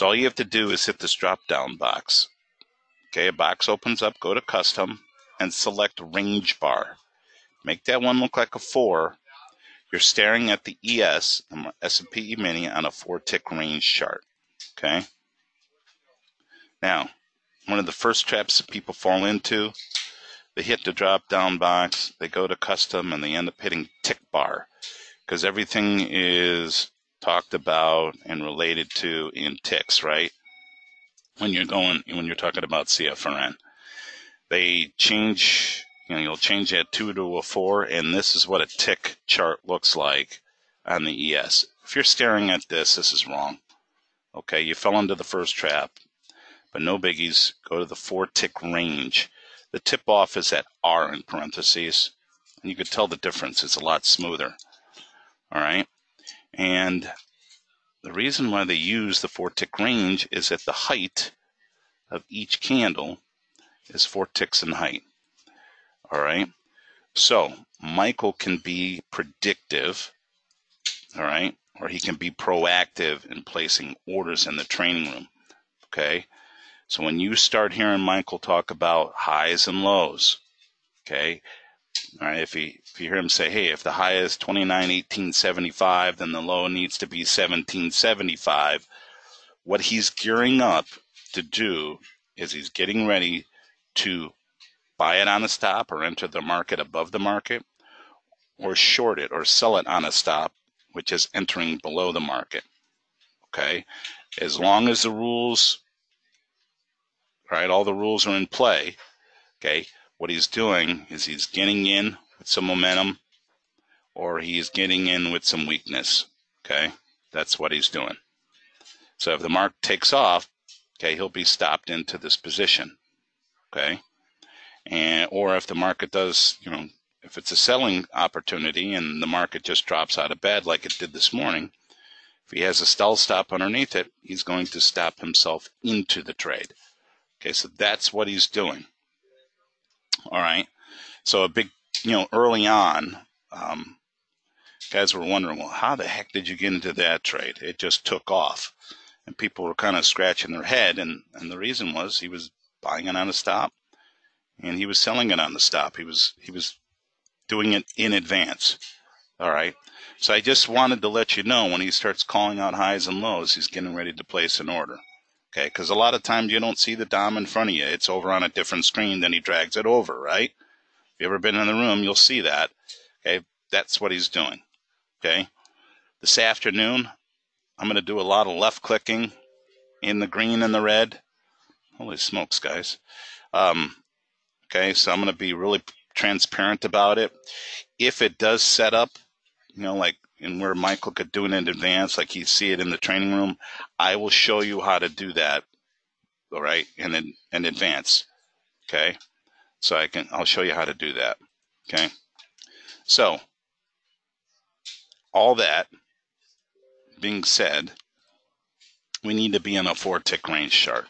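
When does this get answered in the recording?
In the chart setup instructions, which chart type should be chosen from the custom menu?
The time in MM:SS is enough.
00:06.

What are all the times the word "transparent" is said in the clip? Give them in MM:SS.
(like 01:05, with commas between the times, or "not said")
03:06.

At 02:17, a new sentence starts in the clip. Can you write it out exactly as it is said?
Okay, so that's what he's doing.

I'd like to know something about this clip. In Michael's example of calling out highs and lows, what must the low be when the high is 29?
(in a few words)
1775.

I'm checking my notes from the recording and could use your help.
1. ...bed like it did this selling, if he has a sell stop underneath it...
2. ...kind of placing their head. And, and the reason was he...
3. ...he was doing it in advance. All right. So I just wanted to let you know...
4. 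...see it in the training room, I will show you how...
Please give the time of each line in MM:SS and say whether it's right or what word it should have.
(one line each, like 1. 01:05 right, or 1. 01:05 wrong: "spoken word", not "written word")
1. 02:10 wrong: "morning", not "selling"
2. 02:29 wrong: "scratching", not "placing"
3. 02:36 right
4. 03:12 right.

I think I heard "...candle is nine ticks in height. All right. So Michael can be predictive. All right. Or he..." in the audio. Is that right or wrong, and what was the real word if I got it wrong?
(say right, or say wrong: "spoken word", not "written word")
wrong: "four", not "nine".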